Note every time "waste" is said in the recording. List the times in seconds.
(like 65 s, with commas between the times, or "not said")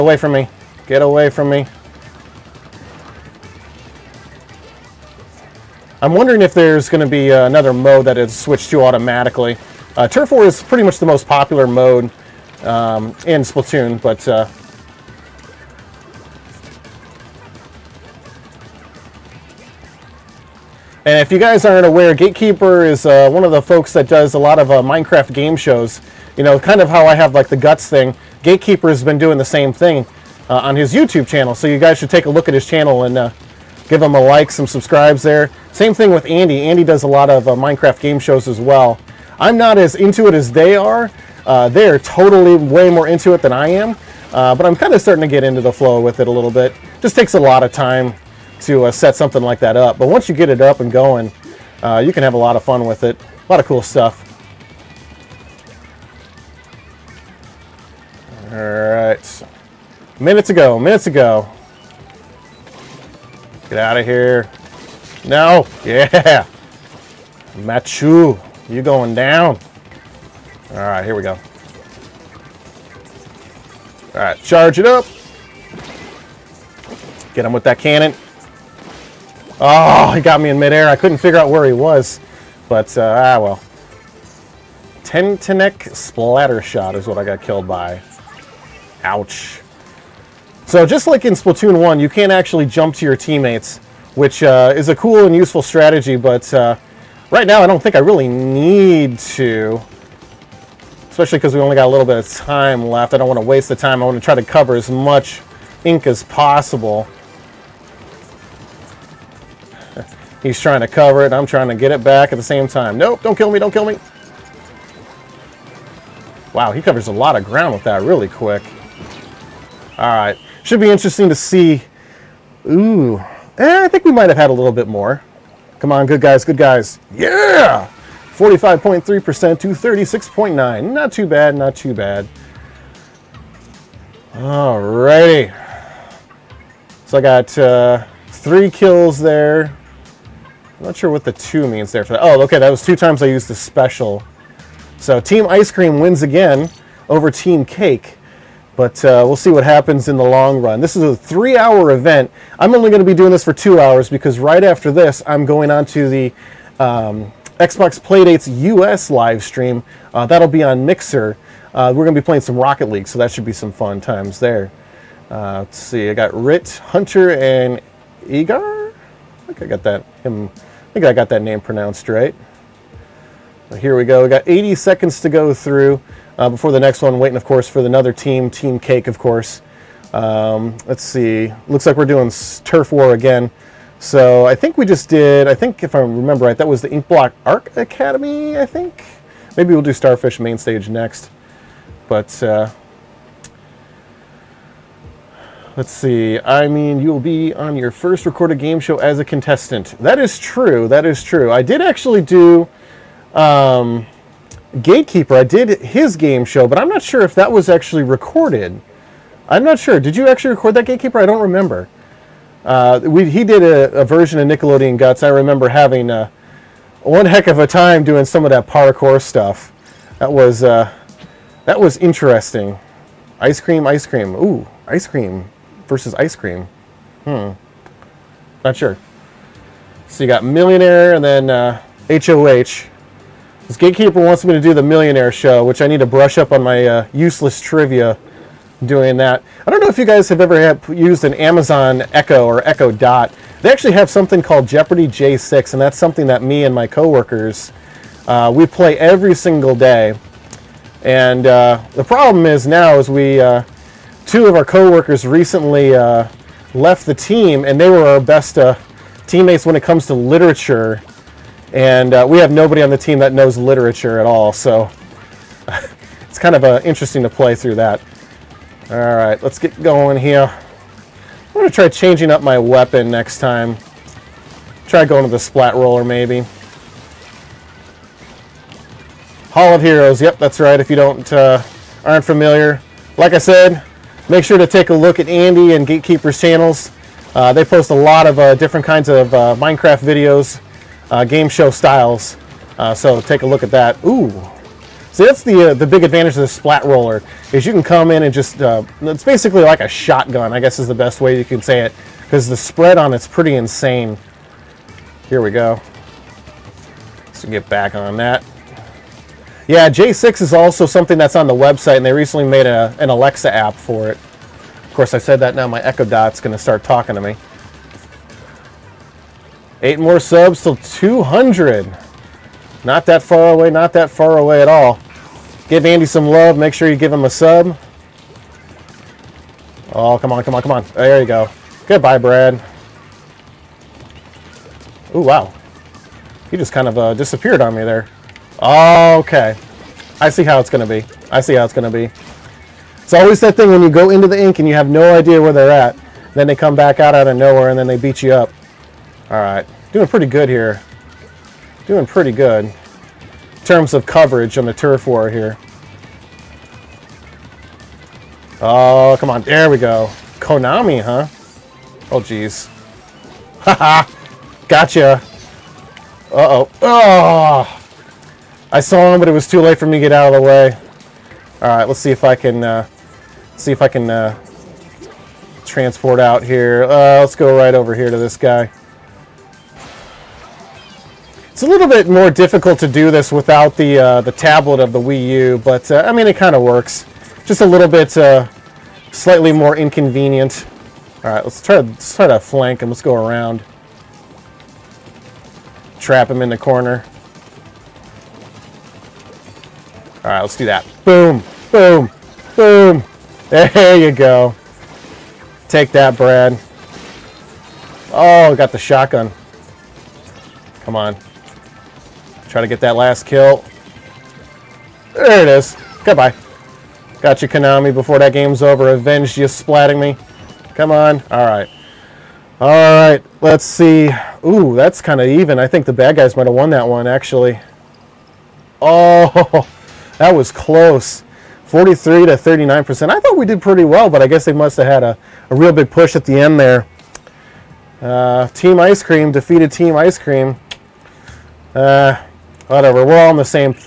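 103 s.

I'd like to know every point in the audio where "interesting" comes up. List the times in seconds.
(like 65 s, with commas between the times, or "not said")
120 s, 221 s, 266 s.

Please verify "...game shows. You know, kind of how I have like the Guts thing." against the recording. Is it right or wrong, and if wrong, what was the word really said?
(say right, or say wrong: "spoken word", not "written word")
right.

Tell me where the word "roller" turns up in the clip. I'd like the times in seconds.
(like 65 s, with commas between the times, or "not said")
275 s, 296 s.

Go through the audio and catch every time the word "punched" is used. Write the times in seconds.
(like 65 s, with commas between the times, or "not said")
not said.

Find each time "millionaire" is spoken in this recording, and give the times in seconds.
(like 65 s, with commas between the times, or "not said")
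230 s, 234 s.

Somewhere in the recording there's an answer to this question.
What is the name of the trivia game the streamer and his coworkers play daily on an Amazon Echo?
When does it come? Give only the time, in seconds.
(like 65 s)
244 s.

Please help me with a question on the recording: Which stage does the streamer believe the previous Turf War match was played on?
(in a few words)
Inkblot Art Academy.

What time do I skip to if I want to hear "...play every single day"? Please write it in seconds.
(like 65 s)
248 s.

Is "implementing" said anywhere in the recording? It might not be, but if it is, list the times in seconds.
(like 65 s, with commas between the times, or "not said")
not said.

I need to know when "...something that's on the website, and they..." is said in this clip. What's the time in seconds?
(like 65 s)
310 s.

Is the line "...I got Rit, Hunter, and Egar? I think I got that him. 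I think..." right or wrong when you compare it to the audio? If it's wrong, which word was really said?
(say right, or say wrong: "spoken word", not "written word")
right.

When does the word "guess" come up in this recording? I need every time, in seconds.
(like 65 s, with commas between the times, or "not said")
300 s, 434 s.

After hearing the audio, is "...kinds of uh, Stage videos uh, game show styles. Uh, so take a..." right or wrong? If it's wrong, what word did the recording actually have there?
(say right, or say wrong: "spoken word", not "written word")
wrong: "Minecraft", not "Stage".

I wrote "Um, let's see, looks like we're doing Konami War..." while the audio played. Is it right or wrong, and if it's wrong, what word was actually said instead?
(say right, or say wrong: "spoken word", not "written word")
wrong: "Turf", not "Konami".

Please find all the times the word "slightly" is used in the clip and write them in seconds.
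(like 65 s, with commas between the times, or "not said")
389 s.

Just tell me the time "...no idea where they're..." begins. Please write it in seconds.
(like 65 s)
344 s.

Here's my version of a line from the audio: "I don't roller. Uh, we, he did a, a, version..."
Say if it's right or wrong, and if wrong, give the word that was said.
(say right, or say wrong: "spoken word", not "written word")
wrong: "remember", not "roller".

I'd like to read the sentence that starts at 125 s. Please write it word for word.
Come on, good guys, good guys.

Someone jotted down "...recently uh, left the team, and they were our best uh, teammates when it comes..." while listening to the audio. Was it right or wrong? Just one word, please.
right.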